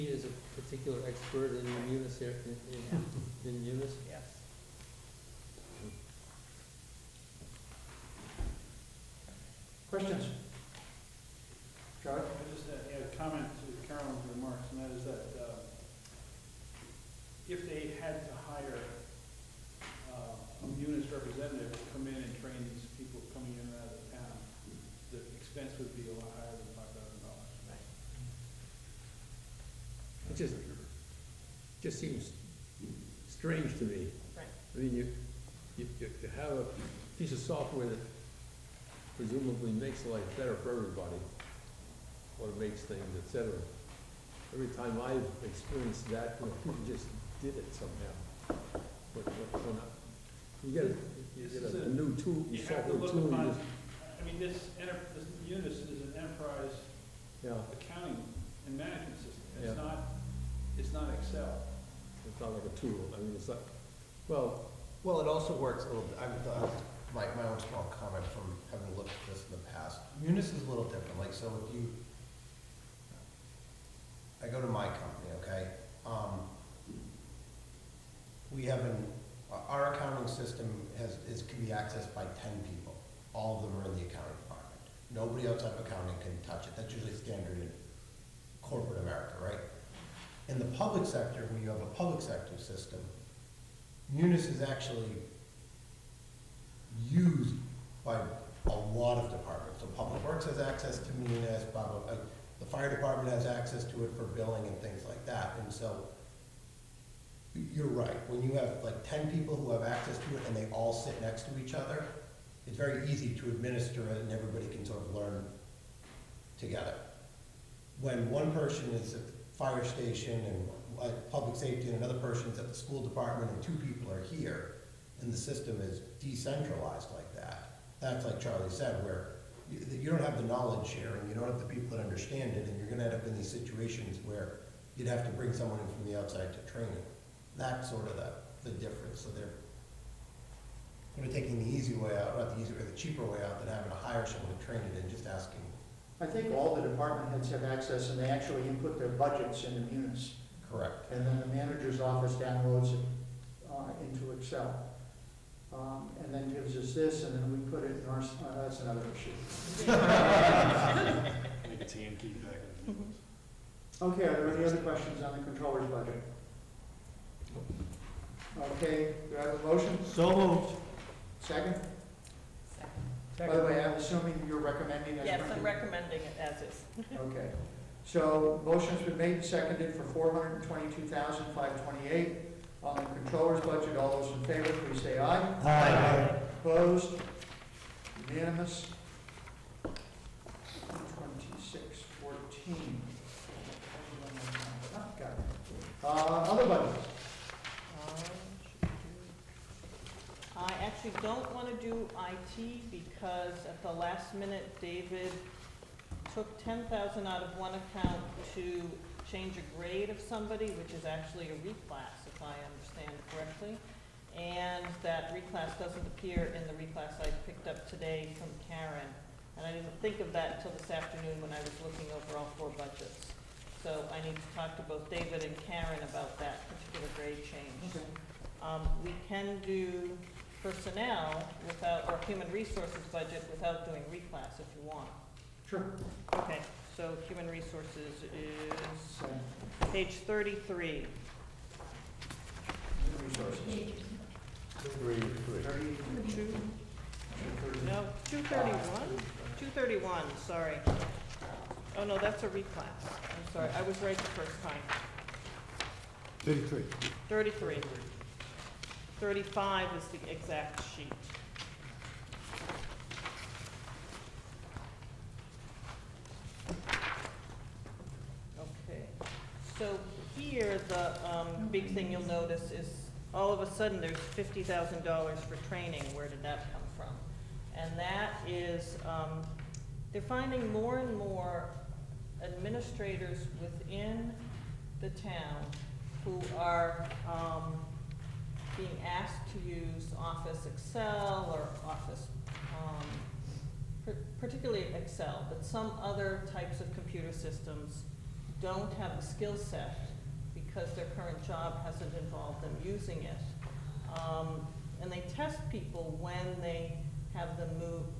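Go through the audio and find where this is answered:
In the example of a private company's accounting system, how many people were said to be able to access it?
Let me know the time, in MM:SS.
01:22.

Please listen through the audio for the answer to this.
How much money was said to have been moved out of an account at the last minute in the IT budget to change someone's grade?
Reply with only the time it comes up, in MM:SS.
03:26.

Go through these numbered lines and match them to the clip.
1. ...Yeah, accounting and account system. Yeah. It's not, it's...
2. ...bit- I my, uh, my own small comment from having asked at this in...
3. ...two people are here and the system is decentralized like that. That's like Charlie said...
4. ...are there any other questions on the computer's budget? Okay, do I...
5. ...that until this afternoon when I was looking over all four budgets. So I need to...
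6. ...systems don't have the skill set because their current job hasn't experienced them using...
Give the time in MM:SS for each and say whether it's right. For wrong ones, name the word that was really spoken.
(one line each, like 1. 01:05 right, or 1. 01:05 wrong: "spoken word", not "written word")
1. 00:57 wrong: "management", not "account"
2. 01:06 wrong: "looked", not "asked"
3. 02:03 right
4. 02:44 wrong: "controller", not "computer"
5. 03:40 right
6. 04:57 wrong: "involved", not "experienced".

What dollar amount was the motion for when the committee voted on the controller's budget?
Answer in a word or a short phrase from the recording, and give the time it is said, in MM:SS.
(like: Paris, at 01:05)
$422,528, at 03:00.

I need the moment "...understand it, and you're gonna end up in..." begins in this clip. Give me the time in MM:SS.
02:12.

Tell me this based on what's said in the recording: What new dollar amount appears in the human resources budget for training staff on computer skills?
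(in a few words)
$50,000.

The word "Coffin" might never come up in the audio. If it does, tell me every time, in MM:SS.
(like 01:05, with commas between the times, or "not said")
not said.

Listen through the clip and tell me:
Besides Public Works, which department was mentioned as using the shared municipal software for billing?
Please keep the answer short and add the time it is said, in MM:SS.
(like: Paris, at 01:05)
the fire department, at 01:42.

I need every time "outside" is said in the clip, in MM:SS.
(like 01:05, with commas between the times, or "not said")
01:25, 02:16.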